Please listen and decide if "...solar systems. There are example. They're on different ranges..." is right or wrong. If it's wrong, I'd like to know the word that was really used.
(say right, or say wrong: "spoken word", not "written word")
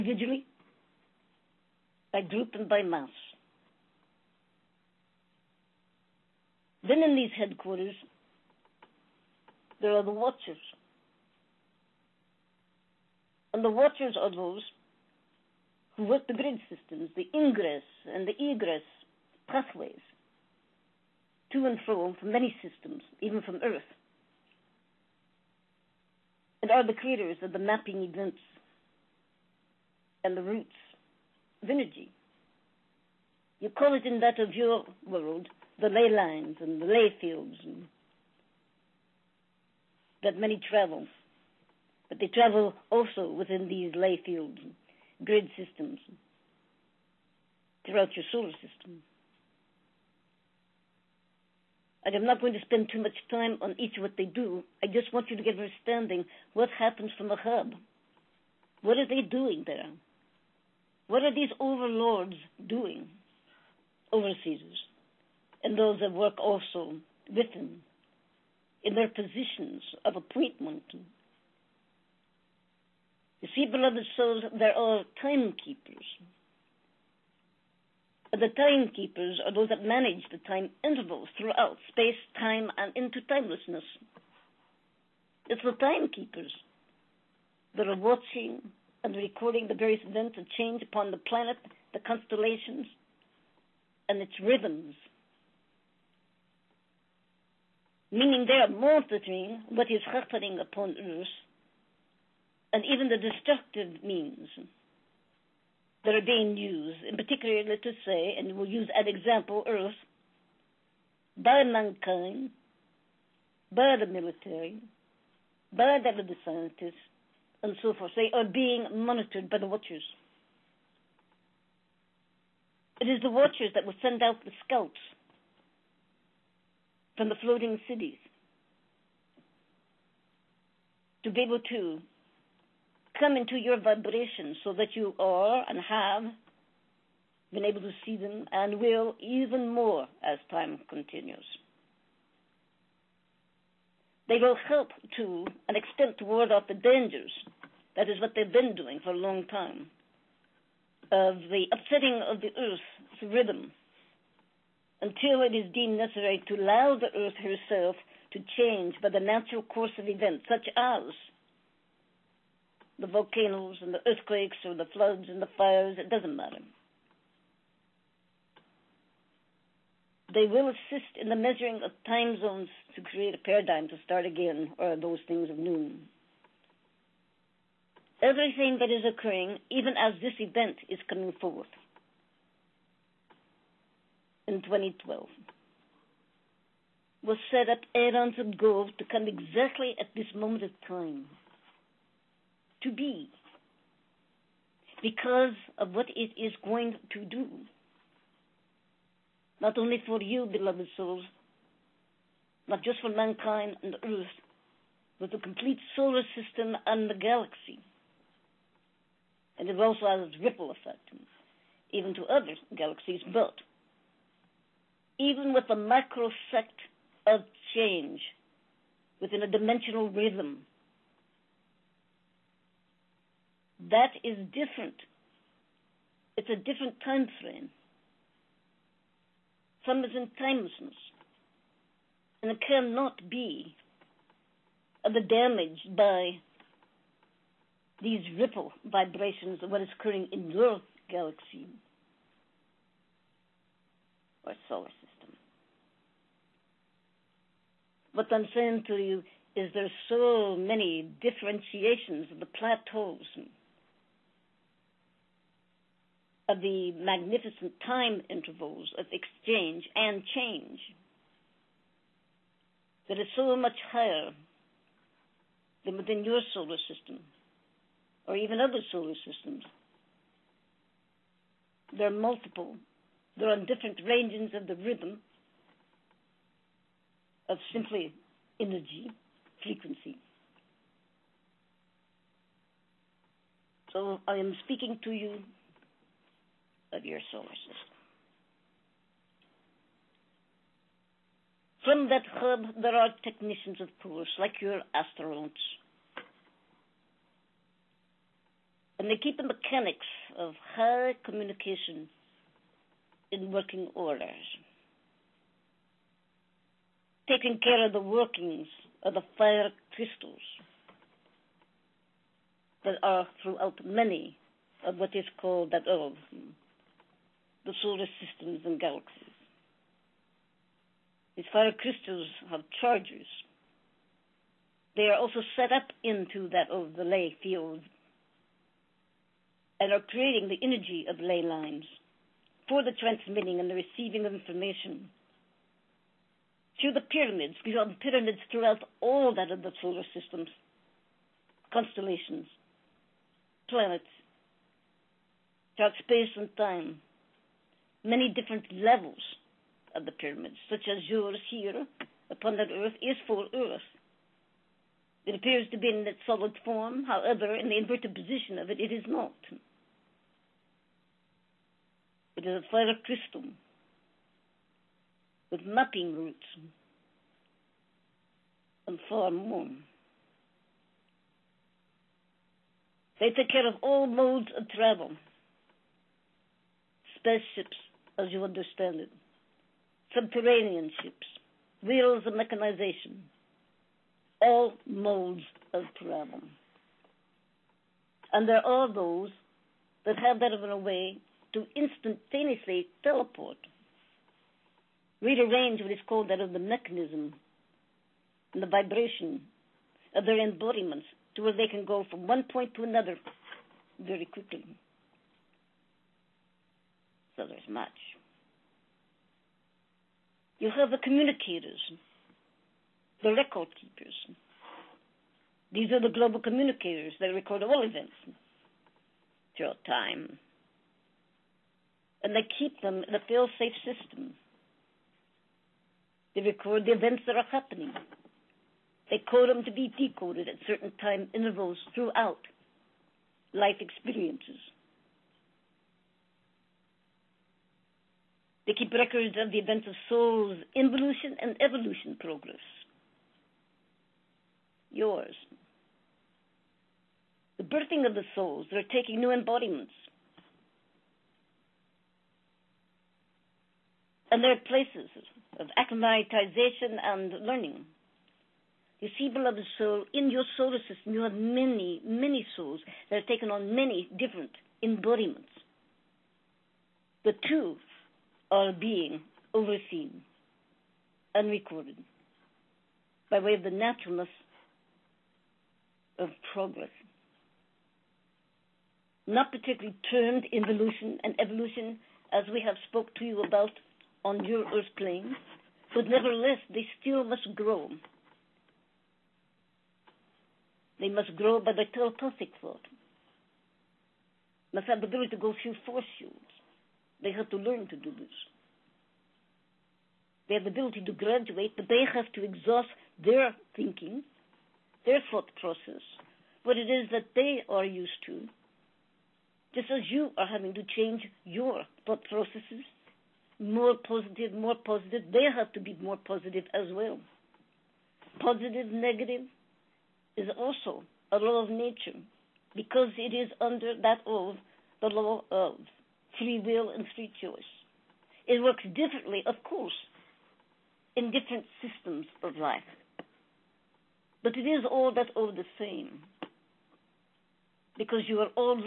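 wrong: "multiple", not "example".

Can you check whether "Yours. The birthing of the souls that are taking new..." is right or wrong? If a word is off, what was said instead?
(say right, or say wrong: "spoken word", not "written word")
right.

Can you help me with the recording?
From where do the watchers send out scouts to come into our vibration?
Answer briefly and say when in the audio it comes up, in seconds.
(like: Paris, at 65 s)
floating cities, at 127 s.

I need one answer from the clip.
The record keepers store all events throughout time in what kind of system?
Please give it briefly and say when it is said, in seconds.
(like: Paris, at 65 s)
fail-safe system, at 423 s.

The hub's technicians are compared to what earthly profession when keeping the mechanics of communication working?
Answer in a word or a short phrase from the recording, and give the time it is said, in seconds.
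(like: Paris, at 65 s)
astronauts, at 294 s.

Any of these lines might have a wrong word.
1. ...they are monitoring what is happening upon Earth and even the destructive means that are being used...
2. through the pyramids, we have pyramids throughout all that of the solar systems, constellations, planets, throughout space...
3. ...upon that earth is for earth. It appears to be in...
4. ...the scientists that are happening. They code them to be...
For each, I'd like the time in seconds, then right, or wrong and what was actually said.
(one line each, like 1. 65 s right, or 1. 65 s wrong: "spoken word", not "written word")
1. 98 s right
2. 336 s right
3. 352 s right
4. 426 s wrong: "events", not "scientists".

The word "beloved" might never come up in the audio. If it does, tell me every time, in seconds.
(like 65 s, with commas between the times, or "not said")
73 s, 200 s, 459 s.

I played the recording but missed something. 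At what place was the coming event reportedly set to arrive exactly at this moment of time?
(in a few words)
Aaron's Grove.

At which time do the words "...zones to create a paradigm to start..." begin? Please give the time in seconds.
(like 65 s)
172 s.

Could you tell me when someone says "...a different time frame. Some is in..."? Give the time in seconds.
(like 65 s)
226 s.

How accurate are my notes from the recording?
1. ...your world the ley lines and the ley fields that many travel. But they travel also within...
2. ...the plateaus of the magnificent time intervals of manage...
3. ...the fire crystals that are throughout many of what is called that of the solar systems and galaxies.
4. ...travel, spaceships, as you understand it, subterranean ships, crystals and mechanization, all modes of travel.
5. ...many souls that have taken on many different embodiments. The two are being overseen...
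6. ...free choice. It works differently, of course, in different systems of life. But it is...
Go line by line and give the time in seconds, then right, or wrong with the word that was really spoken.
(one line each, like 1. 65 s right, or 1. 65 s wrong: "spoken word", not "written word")
1. 34 s right
2. 252 s wrong: "exchange", not "manage"
3. 309 s right
4. 374 s wrong: "wheels", not "crystals"
5. 462 s right
6. 527 s right.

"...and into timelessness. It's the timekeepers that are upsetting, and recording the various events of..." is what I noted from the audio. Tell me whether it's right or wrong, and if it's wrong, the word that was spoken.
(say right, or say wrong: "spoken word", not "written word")
wrong: "watching", not "upsetting".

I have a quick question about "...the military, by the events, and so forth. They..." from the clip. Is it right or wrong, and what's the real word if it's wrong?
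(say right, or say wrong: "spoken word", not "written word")
wrong: "scientists", not "events".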